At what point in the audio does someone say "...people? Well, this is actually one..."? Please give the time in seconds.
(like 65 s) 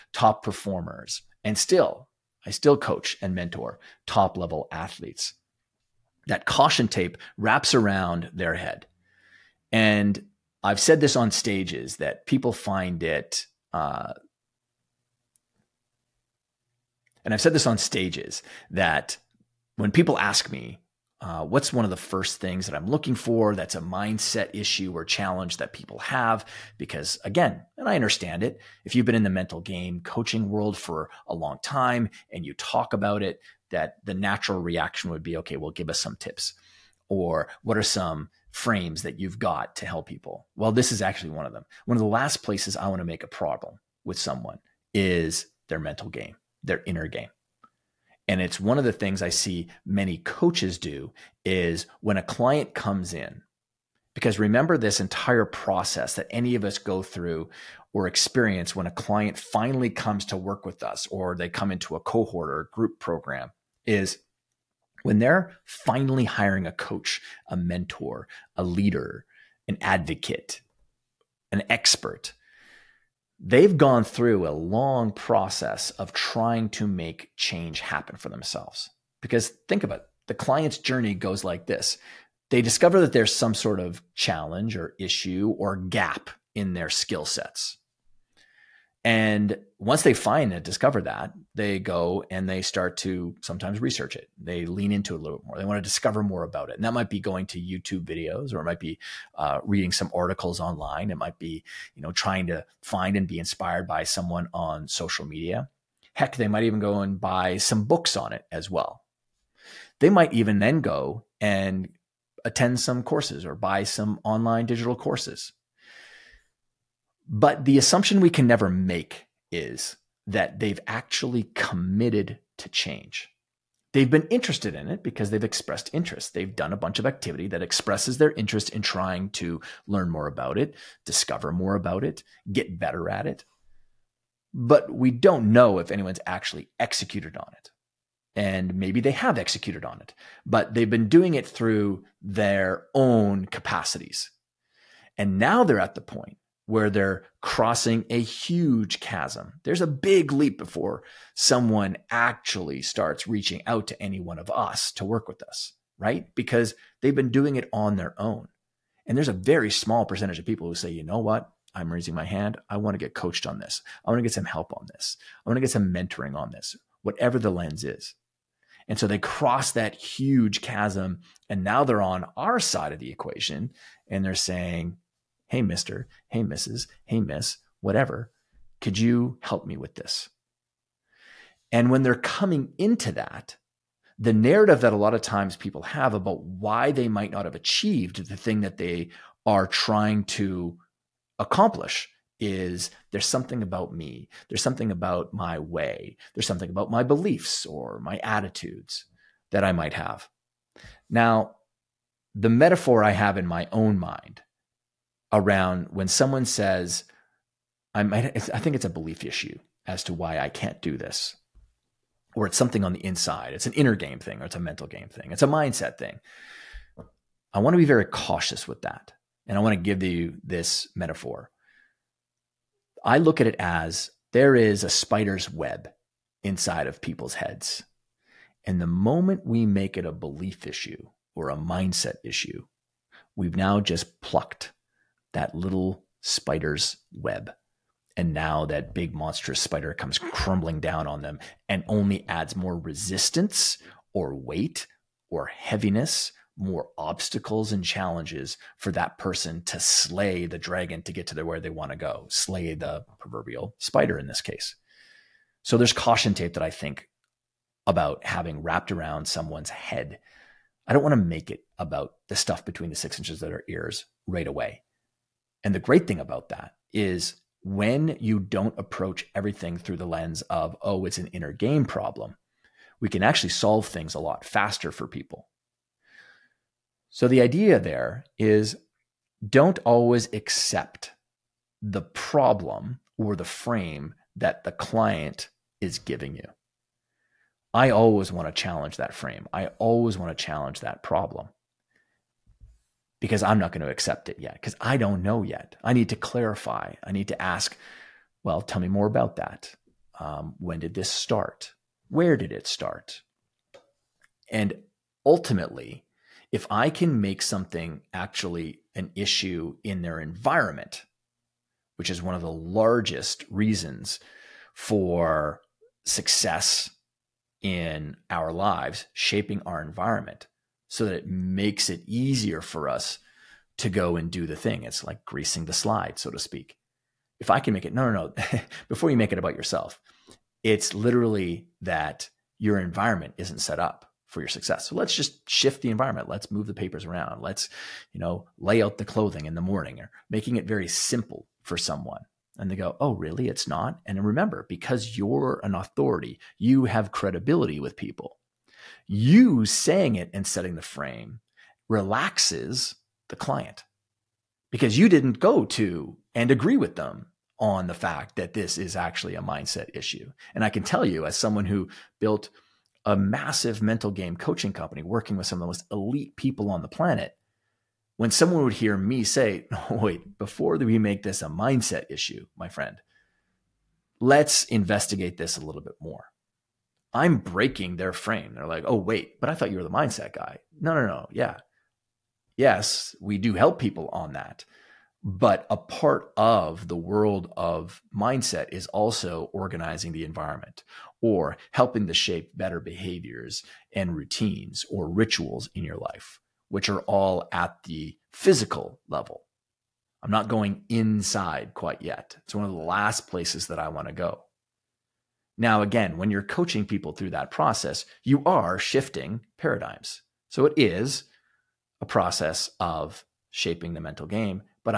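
40 s.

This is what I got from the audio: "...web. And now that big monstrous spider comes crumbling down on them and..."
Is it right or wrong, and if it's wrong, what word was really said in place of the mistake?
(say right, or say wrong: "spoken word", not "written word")
right.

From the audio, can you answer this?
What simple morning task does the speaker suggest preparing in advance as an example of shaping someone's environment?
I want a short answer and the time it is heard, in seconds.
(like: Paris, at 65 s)
Lay out the clothing, at 338 s.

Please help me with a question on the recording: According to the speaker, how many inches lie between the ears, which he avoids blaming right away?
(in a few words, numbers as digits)
6.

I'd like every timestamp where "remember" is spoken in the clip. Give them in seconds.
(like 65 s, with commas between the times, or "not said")
54 s, 344 s.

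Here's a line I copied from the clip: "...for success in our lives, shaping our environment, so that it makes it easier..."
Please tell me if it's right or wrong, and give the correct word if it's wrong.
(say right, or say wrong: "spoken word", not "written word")
right.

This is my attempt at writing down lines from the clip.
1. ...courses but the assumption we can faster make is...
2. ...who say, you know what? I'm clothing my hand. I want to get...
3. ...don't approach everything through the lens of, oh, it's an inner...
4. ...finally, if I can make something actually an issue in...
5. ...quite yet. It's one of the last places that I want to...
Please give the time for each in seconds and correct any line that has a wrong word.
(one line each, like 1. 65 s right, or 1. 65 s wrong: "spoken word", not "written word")
1. 114 s wrong: "never", not "faster"
2. 160 s wrong: "raising", not "clothing"
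3. 268 s right
4. 305 s wrong: "ultimately", not "finally"
5. 401 s right.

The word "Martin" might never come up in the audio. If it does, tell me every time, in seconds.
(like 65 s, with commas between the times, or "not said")
not said.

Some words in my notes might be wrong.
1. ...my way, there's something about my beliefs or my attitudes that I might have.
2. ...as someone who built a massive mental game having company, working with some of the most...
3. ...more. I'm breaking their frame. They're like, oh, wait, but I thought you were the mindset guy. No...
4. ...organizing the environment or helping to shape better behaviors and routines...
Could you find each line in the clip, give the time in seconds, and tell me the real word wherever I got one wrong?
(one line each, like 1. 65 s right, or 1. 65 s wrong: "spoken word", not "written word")
1. 195 s right
2. 361 s wrong: "coaching", not "having"
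3. 375 s right
4. 389 s right.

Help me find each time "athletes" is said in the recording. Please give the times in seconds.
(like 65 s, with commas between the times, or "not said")
4 s.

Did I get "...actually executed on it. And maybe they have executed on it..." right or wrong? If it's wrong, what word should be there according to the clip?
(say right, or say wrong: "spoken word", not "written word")
right.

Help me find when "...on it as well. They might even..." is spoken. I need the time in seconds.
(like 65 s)
108 s.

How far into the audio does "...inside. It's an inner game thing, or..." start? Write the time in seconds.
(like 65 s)
213 s.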